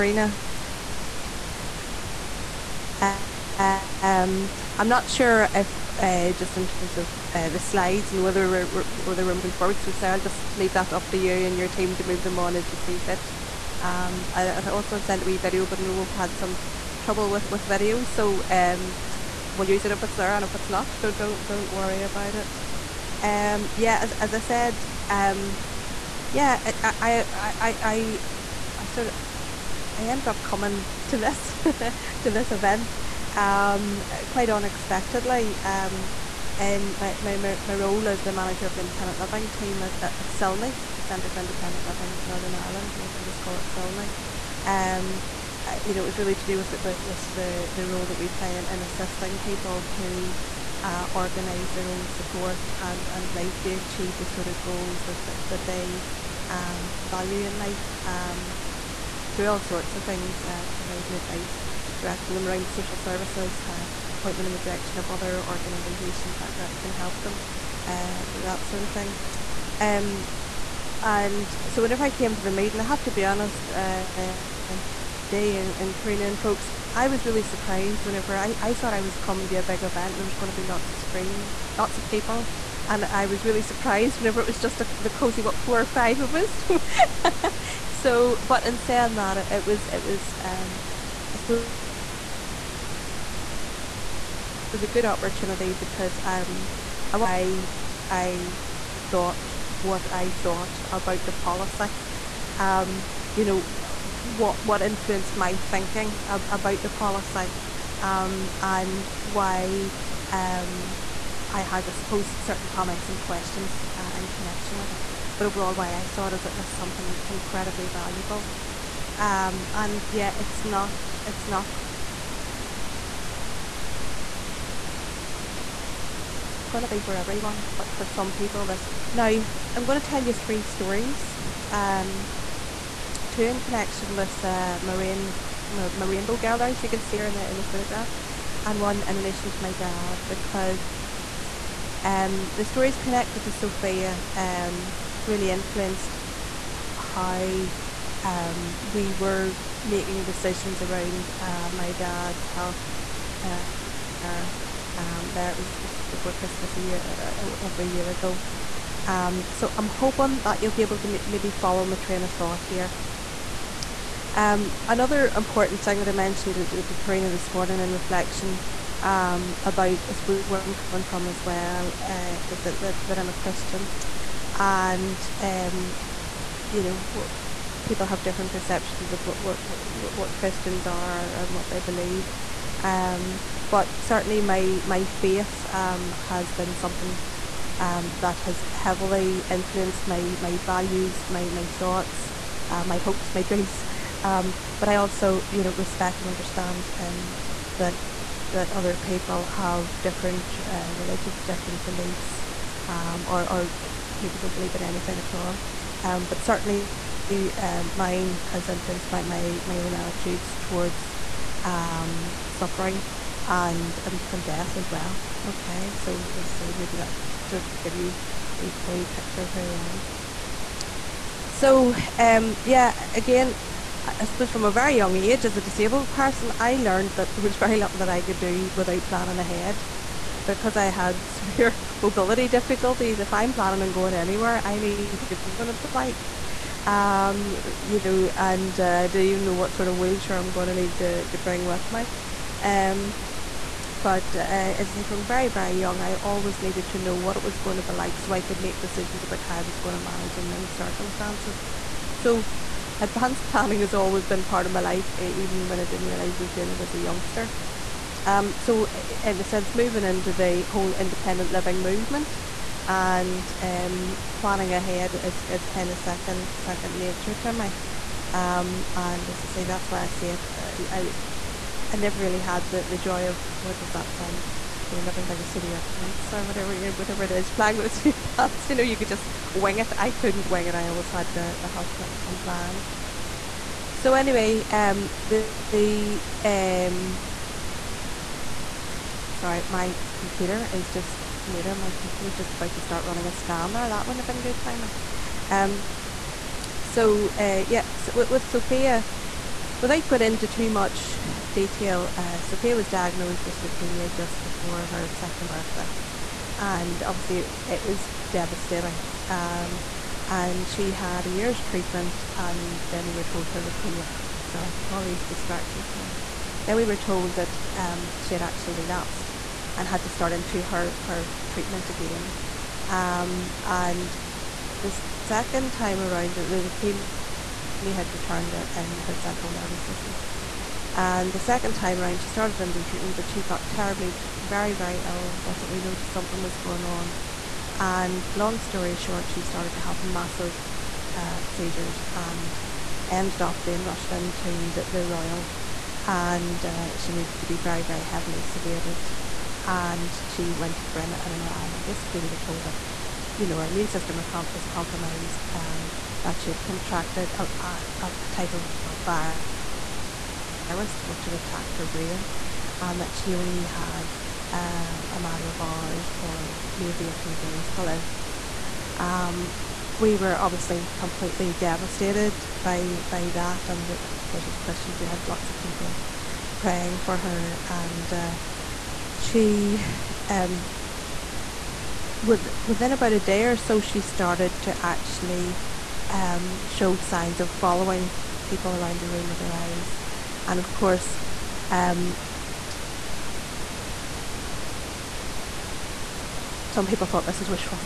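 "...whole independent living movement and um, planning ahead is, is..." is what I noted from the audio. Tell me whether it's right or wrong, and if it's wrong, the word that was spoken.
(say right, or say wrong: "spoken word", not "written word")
right.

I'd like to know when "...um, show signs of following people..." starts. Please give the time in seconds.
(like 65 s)
386 s.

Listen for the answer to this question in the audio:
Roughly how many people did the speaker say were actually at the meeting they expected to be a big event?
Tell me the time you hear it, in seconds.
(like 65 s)
85 s.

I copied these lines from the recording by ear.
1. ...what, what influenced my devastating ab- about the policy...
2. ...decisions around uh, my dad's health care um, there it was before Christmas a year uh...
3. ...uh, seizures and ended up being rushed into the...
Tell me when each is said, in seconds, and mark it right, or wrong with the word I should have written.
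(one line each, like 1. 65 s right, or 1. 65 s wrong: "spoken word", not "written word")
1. 103 s wrong: "thinking", not "devastating"
2. 150 s right
3. 341 s right.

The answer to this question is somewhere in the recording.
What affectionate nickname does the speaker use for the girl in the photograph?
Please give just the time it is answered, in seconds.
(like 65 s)
136 s.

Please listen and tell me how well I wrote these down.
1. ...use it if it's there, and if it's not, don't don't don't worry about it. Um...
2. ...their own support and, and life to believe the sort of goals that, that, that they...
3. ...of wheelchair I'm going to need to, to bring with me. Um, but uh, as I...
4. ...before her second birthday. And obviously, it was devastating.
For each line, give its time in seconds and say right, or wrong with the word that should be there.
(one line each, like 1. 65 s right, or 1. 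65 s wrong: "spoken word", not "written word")
1. 19 s right
2. 51 s wrong: "achieve", not "believe"
3. 239 s right
4. 304 s right.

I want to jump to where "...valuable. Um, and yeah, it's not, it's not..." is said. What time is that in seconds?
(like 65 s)
117 s.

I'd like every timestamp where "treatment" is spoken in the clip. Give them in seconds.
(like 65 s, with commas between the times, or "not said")
311 s, 321 s, 332 s.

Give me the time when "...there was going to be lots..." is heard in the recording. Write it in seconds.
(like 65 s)
80 s.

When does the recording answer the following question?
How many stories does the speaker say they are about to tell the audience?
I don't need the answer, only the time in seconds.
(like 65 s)
130 s.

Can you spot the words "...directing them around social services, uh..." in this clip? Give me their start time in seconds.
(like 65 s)
61 s.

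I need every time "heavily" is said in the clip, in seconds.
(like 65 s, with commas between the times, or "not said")
188 s, 348 s.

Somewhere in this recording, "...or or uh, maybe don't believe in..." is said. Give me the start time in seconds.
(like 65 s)
203 s.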